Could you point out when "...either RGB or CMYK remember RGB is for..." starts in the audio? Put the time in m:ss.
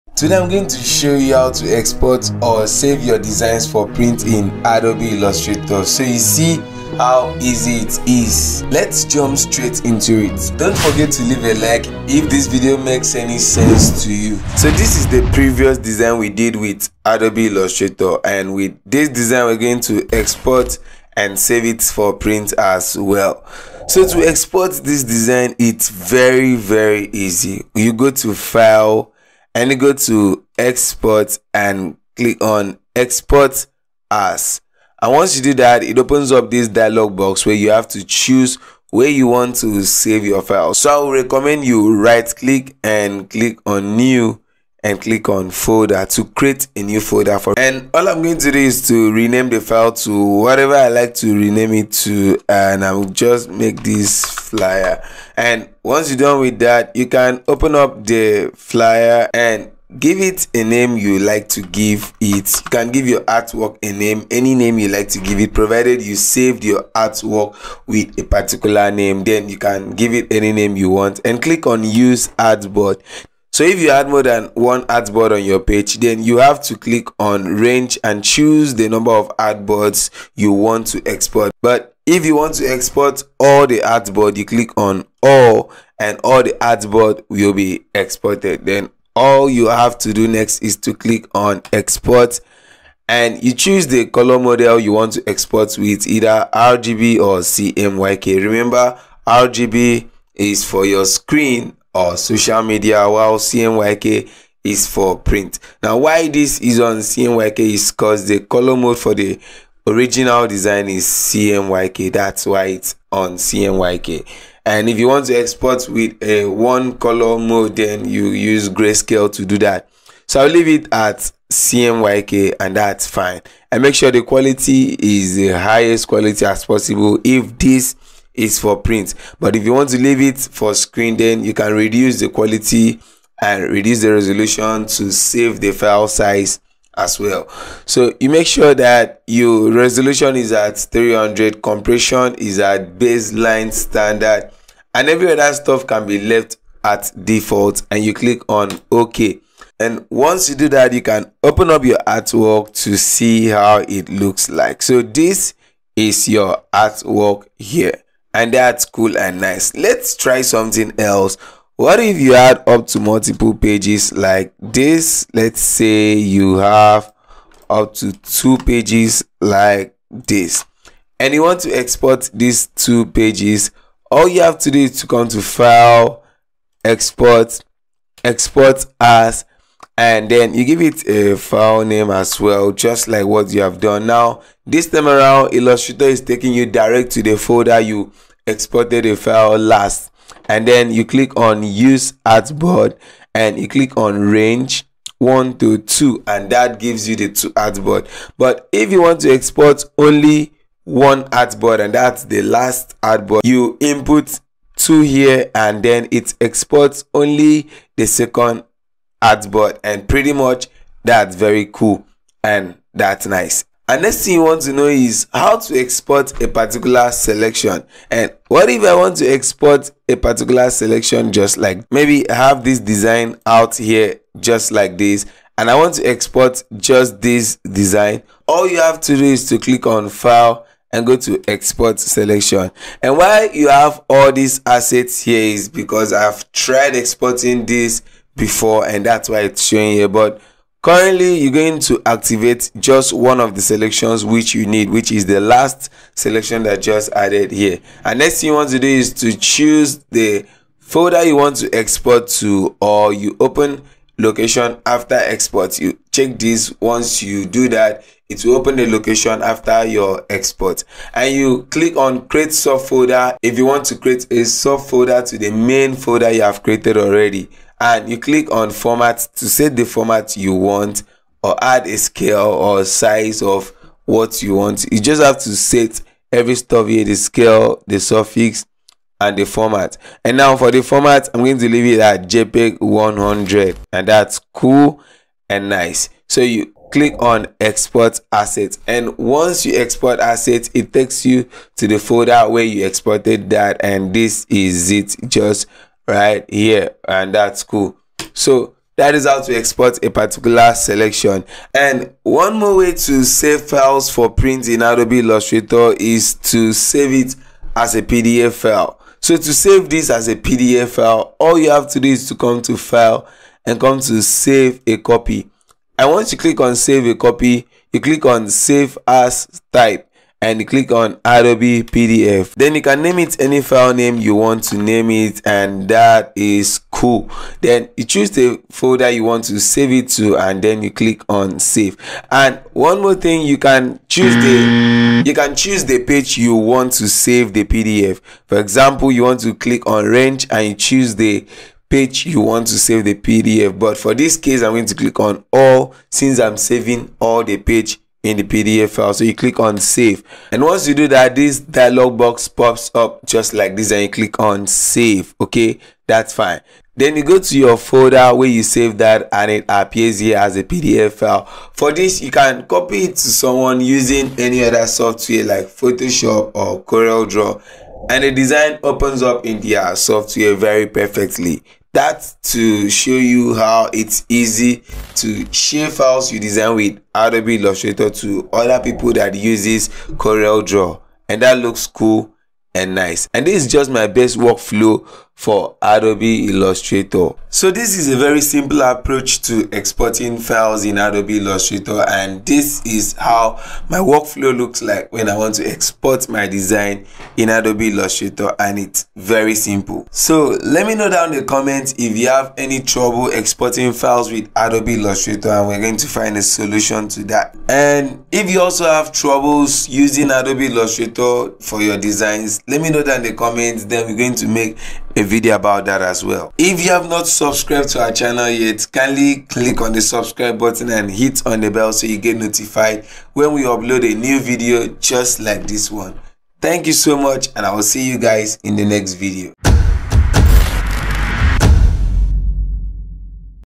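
1:36.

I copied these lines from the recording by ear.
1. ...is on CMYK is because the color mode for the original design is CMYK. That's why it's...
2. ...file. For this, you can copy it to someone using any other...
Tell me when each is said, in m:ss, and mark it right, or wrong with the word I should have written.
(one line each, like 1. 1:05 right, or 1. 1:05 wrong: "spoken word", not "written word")
1. 1:46 right
2. 6:01 right.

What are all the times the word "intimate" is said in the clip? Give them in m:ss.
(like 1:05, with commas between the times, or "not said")
not said.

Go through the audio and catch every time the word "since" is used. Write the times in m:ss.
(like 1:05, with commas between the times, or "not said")
5:46.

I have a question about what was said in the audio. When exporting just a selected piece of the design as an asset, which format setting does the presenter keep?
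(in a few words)
JPEG 100.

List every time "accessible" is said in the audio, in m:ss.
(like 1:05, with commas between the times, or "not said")
not said.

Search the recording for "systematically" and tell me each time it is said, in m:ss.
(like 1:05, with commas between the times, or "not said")
not said.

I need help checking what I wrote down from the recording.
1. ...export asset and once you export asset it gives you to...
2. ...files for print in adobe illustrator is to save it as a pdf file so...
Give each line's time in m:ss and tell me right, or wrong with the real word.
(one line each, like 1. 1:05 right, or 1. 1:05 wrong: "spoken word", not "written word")
1. 4:47 wrong: "takes", not "gives"
2. 5:03 right.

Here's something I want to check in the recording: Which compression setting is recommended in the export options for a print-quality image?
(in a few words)
baseline standard.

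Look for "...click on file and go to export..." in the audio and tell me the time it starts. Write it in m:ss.
3:49.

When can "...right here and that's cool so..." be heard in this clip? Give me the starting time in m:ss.
4:56.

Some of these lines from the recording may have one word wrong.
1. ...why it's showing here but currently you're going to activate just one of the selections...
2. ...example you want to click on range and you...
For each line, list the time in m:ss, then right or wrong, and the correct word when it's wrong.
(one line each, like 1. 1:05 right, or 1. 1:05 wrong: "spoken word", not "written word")
1. 3:59 right
2. 5:38 right.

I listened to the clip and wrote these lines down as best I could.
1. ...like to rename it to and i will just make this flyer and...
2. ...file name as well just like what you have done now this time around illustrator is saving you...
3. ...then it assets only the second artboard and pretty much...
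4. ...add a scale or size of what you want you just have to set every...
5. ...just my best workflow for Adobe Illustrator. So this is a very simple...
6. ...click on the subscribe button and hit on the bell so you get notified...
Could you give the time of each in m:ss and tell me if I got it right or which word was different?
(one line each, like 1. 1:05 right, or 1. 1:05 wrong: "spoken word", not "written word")
1. 0:50 right
2. 3:01 wrong: "taking", not "saving"
3. 3:25 wrong: "exports", not "assets"
4. 4:31 right
5. 6:23 right
6. 6:59 right.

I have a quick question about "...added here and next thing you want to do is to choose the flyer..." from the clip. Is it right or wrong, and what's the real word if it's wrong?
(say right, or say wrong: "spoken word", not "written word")
wrong: "folder", not "flyer".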